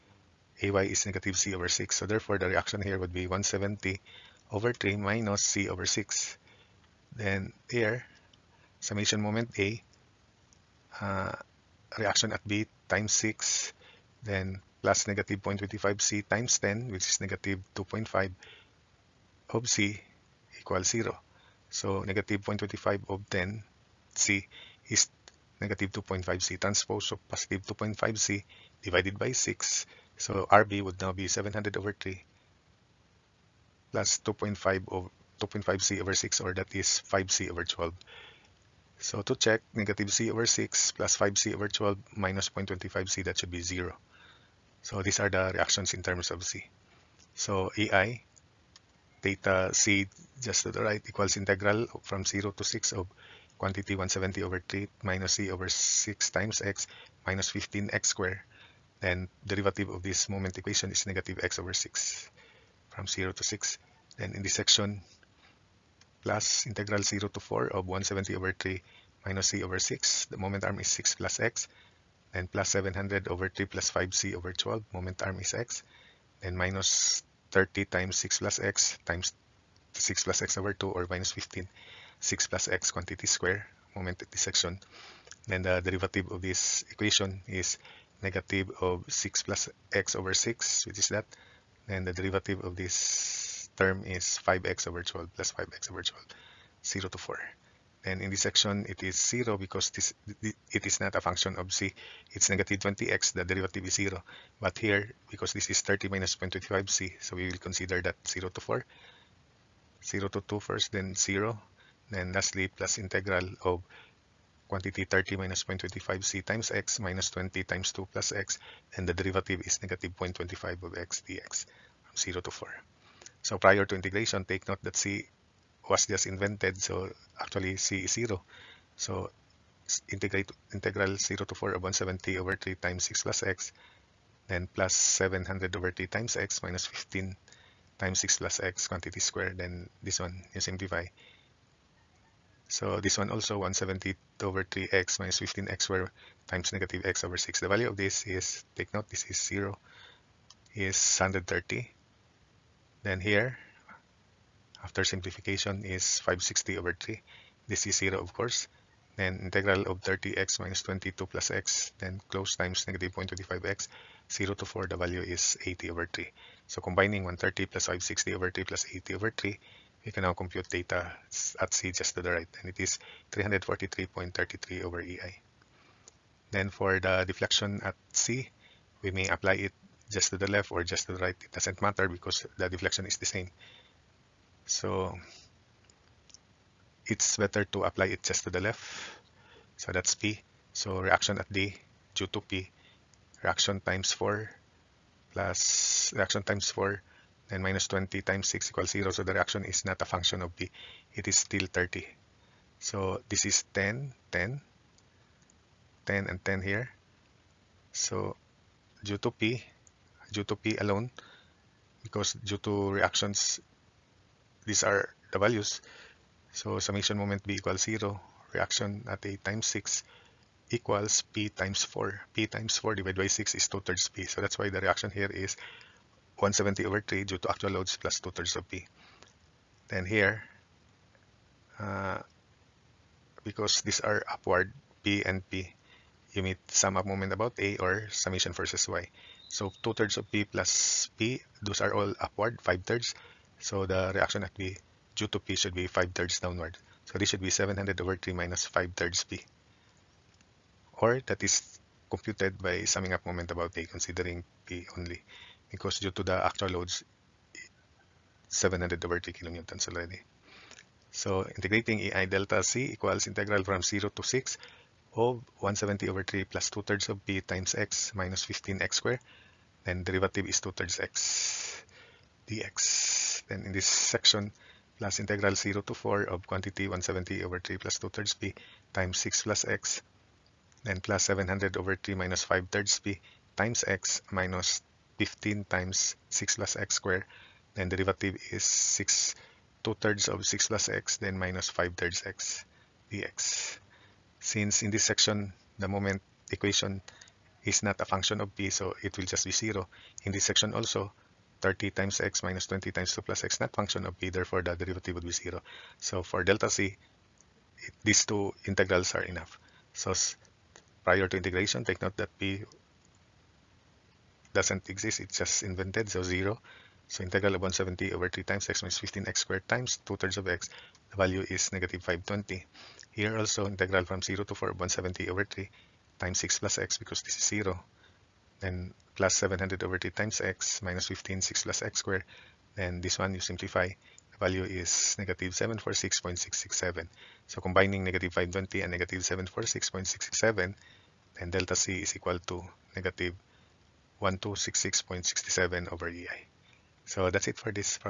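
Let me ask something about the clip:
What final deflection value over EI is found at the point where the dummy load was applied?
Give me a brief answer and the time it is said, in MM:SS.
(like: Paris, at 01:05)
-1266.67, at 05:42.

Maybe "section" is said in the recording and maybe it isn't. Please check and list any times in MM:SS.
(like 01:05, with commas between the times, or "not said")
01:04, 01:24, 01:38, 04:33, 04:55, 05:00.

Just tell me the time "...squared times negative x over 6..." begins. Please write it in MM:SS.
02:25.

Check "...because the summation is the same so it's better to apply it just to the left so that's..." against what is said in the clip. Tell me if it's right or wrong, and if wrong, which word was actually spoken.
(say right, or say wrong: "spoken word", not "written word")
wrong: "deflection", not "summation".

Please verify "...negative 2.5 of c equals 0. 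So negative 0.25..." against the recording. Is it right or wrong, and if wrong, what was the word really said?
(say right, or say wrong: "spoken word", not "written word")
right.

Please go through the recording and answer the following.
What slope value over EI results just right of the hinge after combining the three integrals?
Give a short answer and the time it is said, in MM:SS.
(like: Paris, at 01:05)
343.33, at 02:53.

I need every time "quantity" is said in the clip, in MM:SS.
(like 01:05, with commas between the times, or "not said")
00:53, 01:22, 01:54, 02:18, 04:36.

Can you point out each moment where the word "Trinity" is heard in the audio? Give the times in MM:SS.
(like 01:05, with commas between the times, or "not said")
not said.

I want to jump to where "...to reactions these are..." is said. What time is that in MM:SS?
03:32.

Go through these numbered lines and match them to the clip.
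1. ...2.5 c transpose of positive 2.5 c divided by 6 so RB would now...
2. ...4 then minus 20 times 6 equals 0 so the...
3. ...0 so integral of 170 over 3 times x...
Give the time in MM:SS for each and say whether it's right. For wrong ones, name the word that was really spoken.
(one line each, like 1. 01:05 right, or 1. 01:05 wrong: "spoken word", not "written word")
1. 00:25 right
2. 03:16 right
3. 05:16 right.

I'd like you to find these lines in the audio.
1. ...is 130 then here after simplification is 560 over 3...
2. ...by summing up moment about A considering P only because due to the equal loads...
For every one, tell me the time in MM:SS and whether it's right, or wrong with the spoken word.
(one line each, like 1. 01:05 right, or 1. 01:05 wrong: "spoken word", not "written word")
1. 02:30 right
2. 04:12 wrong: "actual", not "equal".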